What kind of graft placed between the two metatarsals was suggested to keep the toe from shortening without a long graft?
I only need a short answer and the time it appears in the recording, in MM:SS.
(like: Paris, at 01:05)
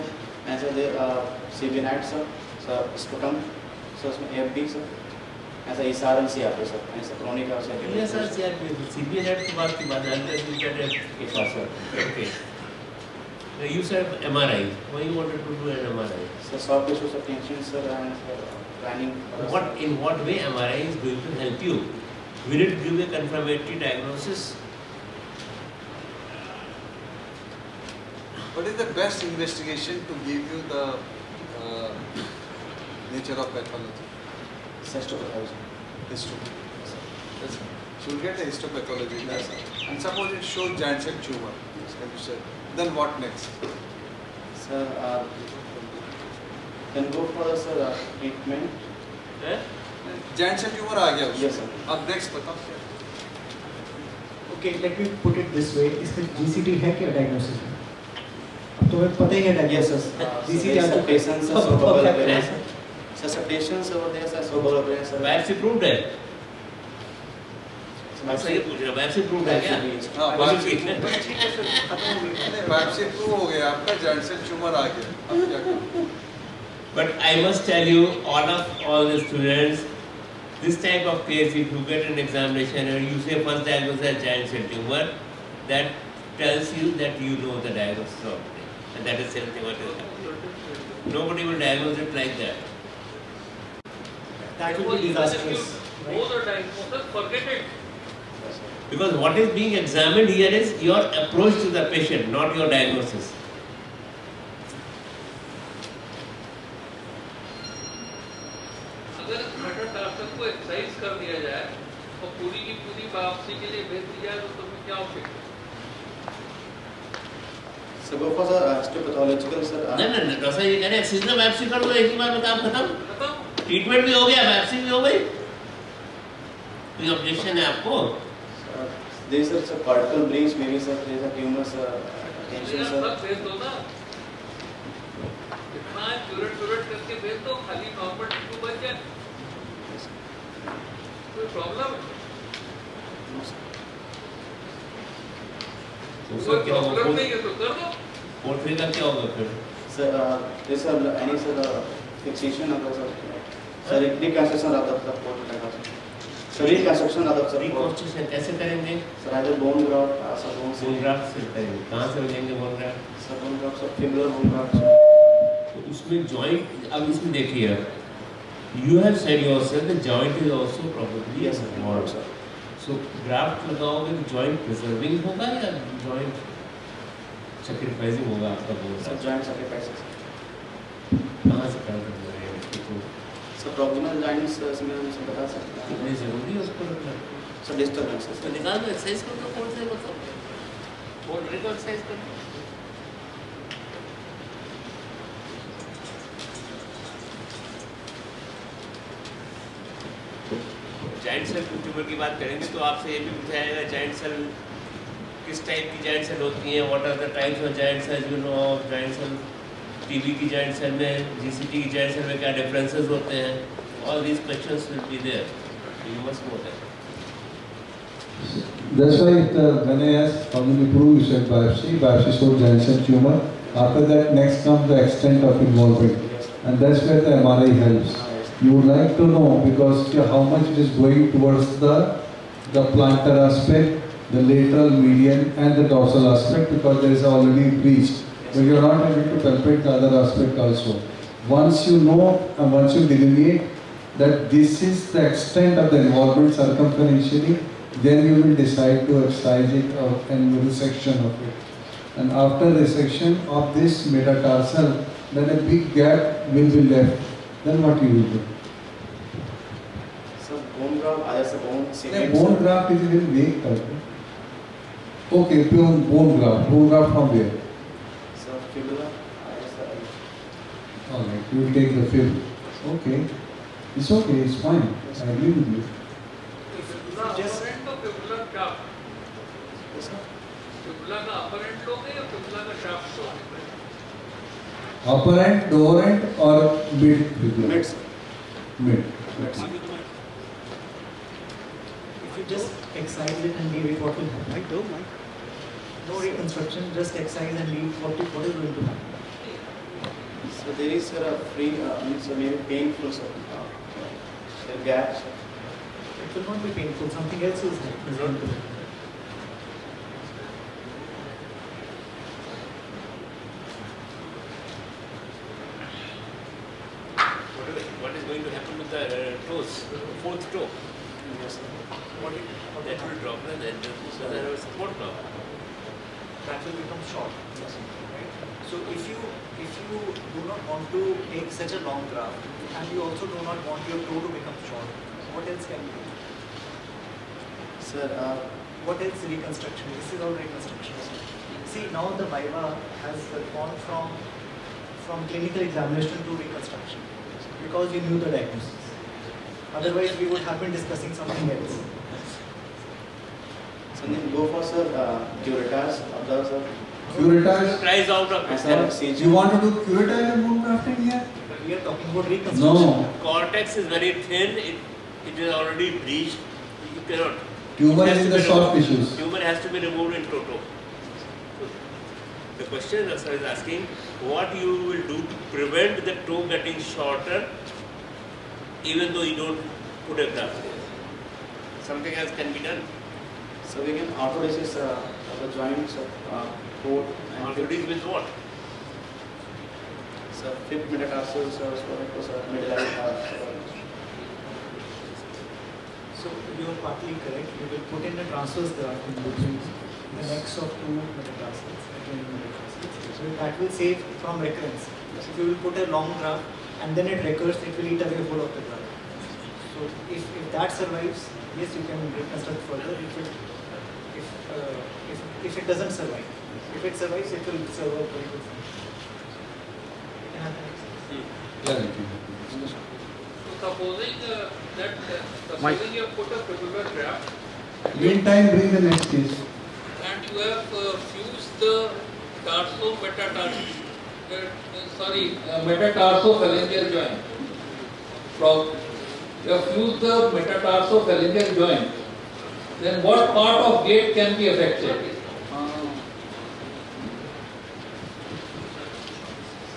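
Transverse graft, at 06:38.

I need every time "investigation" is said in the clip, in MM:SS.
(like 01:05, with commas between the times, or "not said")
00:29.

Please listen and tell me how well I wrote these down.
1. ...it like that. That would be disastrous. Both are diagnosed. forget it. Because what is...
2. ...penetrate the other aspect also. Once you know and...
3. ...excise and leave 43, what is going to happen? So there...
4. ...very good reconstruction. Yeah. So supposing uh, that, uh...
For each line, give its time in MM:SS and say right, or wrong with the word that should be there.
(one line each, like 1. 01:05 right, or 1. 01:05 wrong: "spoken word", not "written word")
1. 01:31 right
2. 03:59 right
3. 04:57 wrong: "40", not "43"
4. 06:58 wrong: "function", not "reconstruction".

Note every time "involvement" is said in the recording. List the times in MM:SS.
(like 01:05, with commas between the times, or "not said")
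03:45, 04:06.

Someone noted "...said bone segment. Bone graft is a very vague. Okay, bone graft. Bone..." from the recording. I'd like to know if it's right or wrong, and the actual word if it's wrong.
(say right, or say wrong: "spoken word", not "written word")
right.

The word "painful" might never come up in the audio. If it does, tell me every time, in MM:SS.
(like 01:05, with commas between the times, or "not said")
05:02, 05:06.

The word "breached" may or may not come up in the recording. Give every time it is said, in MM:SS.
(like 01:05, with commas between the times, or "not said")
03:57, 06:05.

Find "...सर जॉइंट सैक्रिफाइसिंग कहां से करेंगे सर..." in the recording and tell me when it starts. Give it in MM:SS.
02:59.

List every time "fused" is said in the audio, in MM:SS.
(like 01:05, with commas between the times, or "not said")
07:11, 07:19.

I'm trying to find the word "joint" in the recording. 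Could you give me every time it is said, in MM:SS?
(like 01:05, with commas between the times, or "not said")
06:25, 07:16, 07:21.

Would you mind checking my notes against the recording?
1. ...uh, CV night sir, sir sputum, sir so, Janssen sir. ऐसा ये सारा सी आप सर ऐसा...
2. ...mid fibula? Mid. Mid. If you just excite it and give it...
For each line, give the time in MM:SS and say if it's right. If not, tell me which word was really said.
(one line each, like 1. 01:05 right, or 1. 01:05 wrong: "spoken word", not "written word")
1. 00:00 wrong: "AFB", not "Janssen"
2. 04:46 right.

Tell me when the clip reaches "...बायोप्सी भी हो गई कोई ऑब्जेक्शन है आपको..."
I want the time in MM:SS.
02:04.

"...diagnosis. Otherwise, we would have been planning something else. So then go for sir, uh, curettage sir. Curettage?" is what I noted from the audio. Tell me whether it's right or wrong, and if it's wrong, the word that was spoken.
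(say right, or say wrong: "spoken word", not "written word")
wrong: "discussing", not "planning".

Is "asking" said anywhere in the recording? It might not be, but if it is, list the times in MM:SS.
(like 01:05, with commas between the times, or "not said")
06:13.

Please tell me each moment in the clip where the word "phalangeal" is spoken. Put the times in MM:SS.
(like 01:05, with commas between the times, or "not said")
07:16, 07:21.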